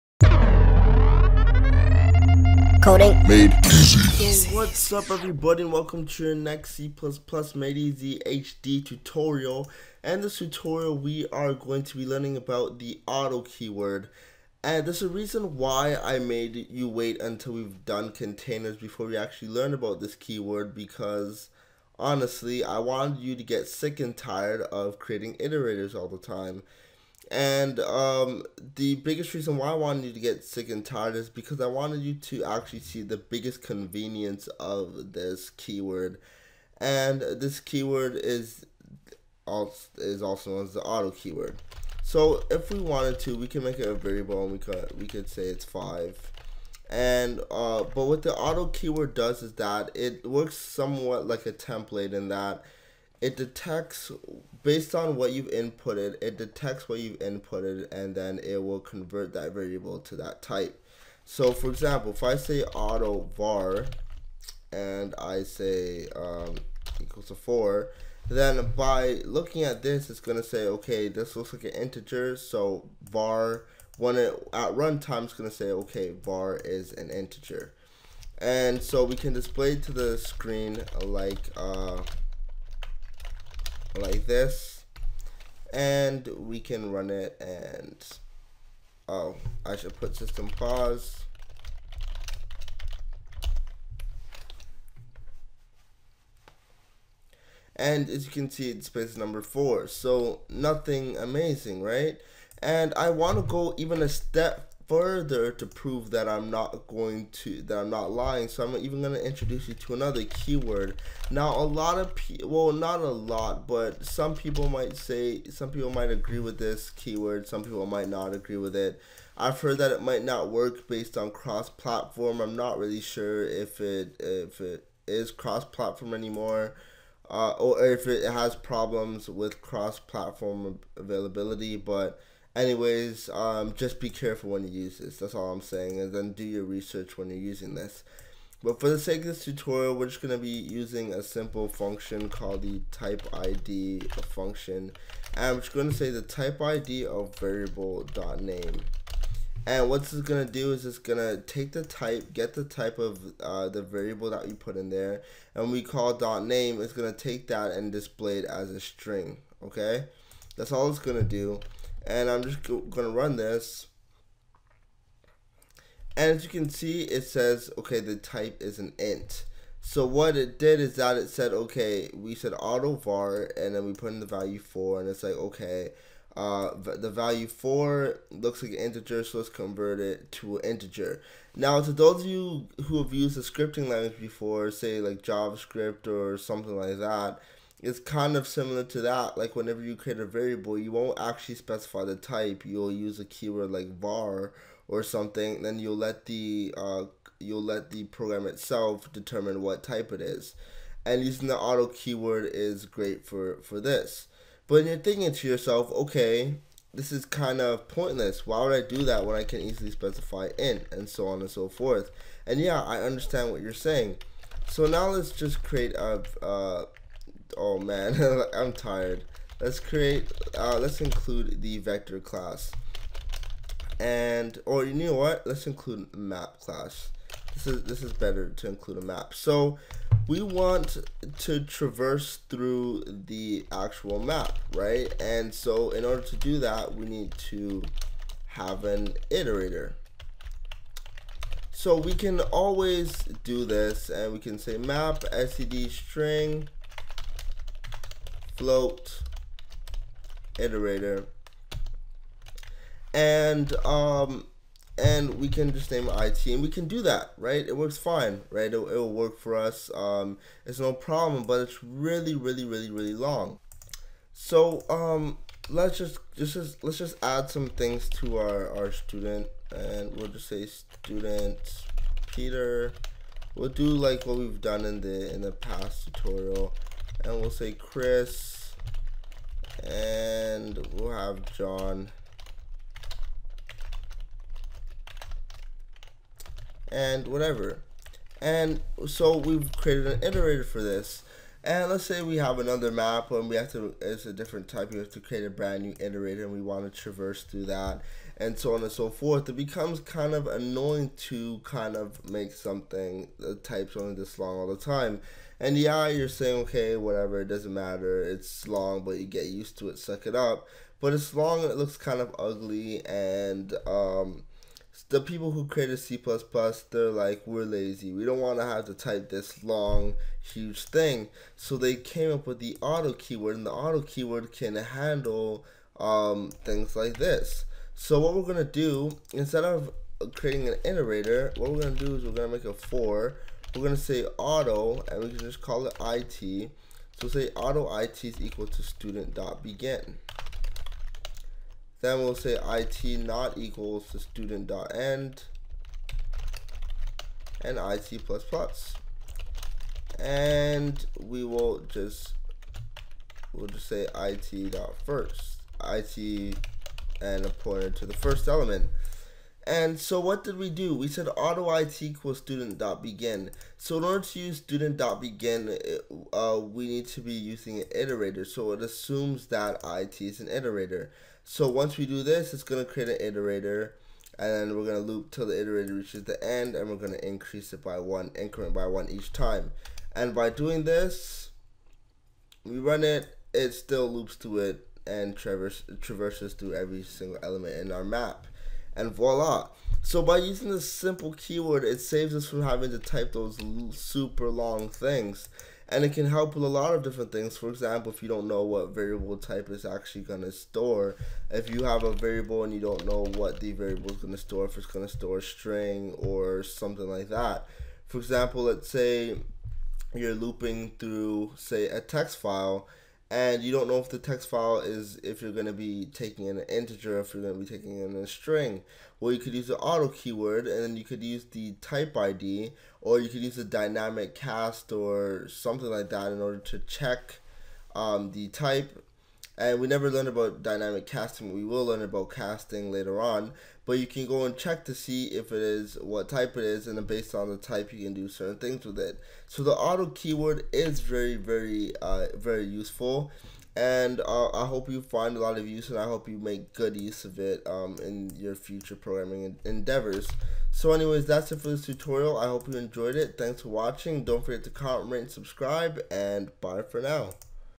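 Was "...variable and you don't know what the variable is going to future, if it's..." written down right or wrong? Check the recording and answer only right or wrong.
wrong.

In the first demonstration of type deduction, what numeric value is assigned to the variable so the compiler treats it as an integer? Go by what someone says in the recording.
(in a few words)
4.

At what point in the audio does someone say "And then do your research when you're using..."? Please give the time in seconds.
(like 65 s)
136 s.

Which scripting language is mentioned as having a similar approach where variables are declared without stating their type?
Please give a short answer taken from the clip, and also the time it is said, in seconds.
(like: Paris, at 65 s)
JavaScript, at 185 s.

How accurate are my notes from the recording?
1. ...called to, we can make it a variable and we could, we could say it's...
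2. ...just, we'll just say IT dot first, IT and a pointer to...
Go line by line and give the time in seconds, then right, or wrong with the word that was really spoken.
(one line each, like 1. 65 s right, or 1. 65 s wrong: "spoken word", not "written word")
1. 42 s wrong: "wanted", not "called"
2. 351 s right.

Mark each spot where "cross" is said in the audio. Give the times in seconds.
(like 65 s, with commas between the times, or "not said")
121 s, 125 s, 129 s.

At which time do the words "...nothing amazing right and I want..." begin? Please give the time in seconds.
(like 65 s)
100 s.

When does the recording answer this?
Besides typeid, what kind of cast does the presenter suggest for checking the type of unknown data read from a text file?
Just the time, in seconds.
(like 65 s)
423 s.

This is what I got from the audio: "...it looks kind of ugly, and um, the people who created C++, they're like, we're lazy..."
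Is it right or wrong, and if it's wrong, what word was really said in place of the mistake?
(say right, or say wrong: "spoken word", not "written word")
right.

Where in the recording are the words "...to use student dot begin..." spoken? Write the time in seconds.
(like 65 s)
364 s.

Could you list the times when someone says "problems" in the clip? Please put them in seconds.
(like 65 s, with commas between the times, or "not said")
128 s, 260 s.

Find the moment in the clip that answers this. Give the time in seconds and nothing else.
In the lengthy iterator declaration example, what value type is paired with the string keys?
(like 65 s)
248 s.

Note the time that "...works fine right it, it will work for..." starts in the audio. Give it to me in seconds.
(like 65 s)
257 s.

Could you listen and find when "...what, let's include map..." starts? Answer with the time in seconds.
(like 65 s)
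225 s.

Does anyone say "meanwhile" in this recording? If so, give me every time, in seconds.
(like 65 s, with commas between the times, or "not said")
not said.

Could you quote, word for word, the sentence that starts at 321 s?
So they came up with the auto keyword, and the auto keyword can handle um, things like this.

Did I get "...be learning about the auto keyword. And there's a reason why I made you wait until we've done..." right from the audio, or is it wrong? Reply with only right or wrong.
right.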